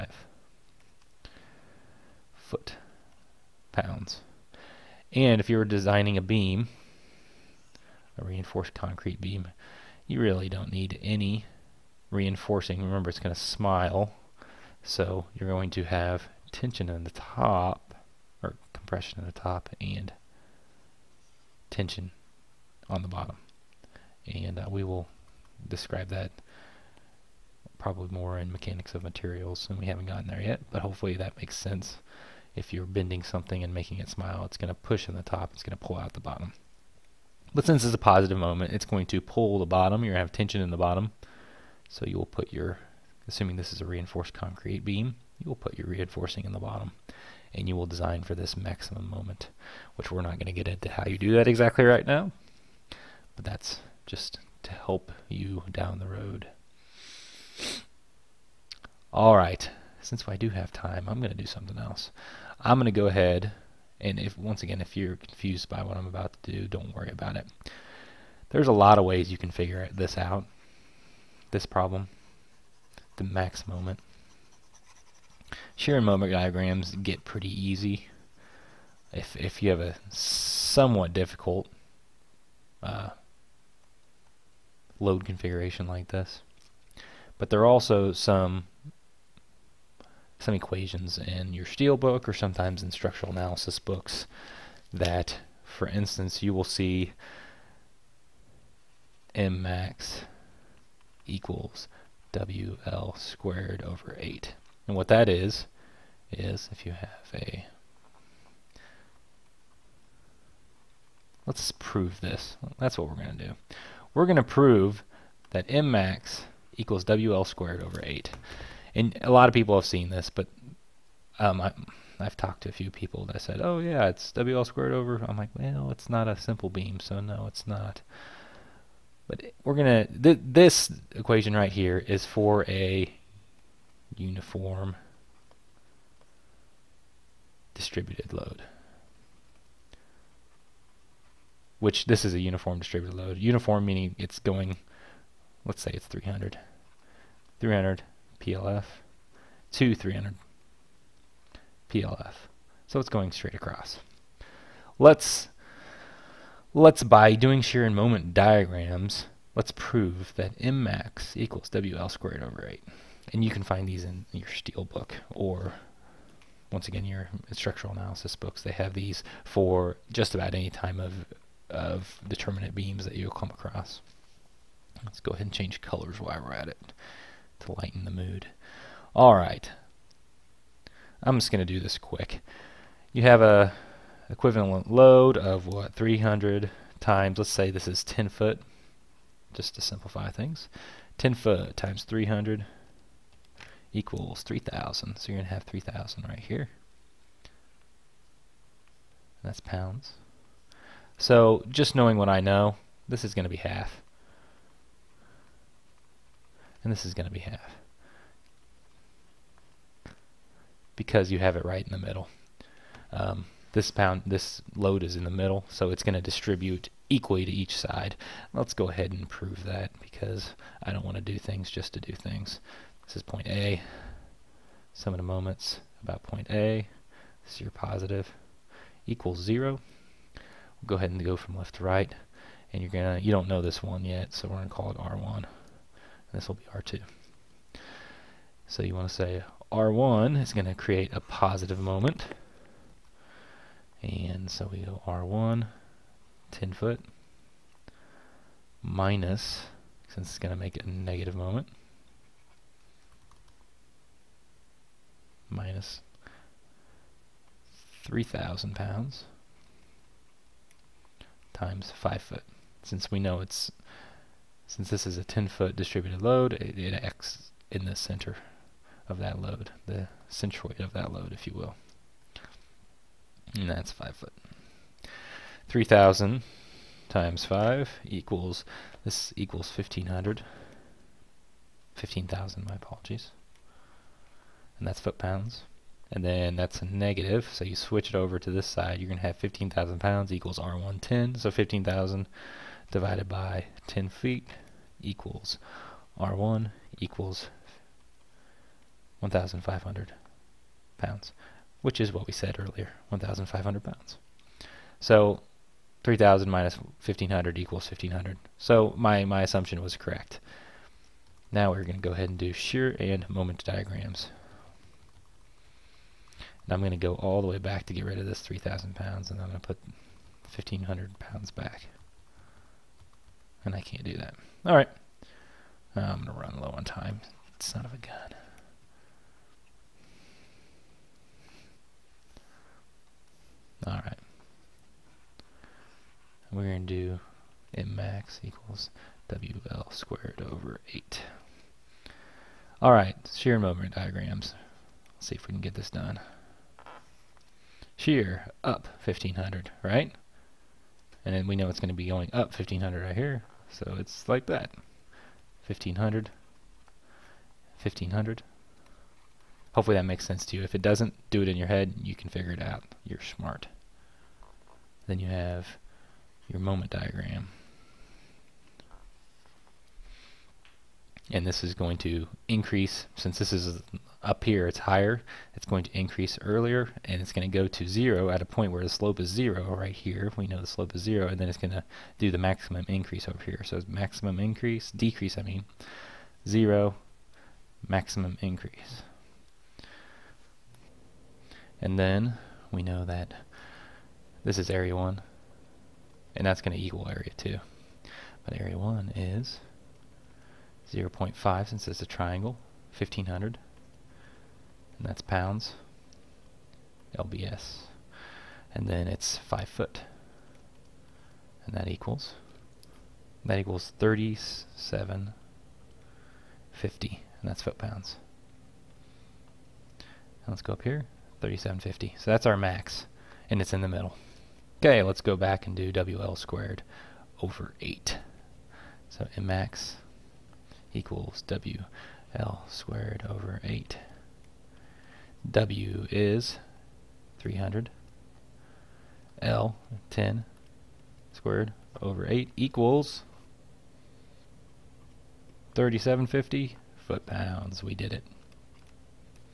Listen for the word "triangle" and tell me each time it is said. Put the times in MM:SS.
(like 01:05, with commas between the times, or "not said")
06:42.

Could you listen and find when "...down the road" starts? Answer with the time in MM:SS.
00:55.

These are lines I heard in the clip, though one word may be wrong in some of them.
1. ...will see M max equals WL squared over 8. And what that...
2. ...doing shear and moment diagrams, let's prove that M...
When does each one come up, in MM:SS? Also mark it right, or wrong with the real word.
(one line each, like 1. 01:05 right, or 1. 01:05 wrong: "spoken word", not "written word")
1. 01:36 right
2. 02:37 right.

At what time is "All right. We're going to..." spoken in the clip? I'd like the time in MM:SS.
05:33.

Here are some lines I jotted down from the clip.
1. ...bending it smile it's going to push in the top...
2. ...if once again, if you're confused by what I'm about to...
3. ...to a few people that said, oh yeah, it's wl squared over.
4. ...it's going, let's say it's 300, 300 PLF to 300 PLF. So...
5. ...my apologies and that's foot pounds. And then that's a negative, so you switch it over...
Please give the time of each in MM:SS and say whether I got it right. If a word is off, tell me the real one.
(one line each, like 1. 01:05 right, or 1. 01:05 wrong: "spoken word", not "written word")
1. 00:33 wrong: "making", not "bending"
2. 01:04 right
3. 02:02 right
4. 02:24 right
5. 04:42 right.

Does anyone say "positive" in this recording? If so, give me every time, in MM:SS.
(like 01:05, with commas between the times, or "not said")
00:37, 03:47, 04:01.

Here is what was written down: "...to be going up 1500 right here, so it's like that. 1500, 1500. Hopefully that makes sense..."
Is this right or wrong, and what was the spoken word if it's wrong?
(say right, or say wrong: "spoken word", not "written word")
right.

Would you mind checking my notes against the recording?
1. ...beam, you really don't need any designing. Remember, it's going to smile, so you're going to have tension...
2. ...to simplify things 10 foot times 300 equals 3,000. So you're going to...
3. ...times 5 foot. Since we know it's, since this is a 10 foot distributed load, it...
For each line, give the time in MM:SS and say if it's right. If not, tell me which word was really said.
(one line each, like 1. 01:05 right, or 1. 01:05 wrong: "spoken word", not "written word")
1. 00:09 wrong: "reinforcing", not "designing"
2. 03:09 right
3. 04:21 right.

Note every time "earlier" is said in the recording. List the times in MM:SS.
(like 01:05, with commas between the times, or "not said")
05:02, 06:16.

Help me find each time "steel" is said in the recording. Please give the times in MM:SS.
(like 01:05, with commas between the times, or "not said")
01:31, 02:44.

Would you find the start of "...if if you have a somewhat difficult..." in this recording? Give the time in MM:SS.
01:19.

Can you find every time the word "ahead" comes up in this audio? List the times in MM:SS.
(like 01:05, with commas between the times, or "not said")
01:03, 02:55, 03:38, 03:50, 05:12.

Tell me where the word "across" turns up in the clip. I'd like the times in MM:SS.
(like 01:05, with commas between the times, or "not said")
02:33, 02:53.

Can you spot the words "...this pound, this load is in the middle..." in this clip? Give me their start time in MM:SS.
03:33.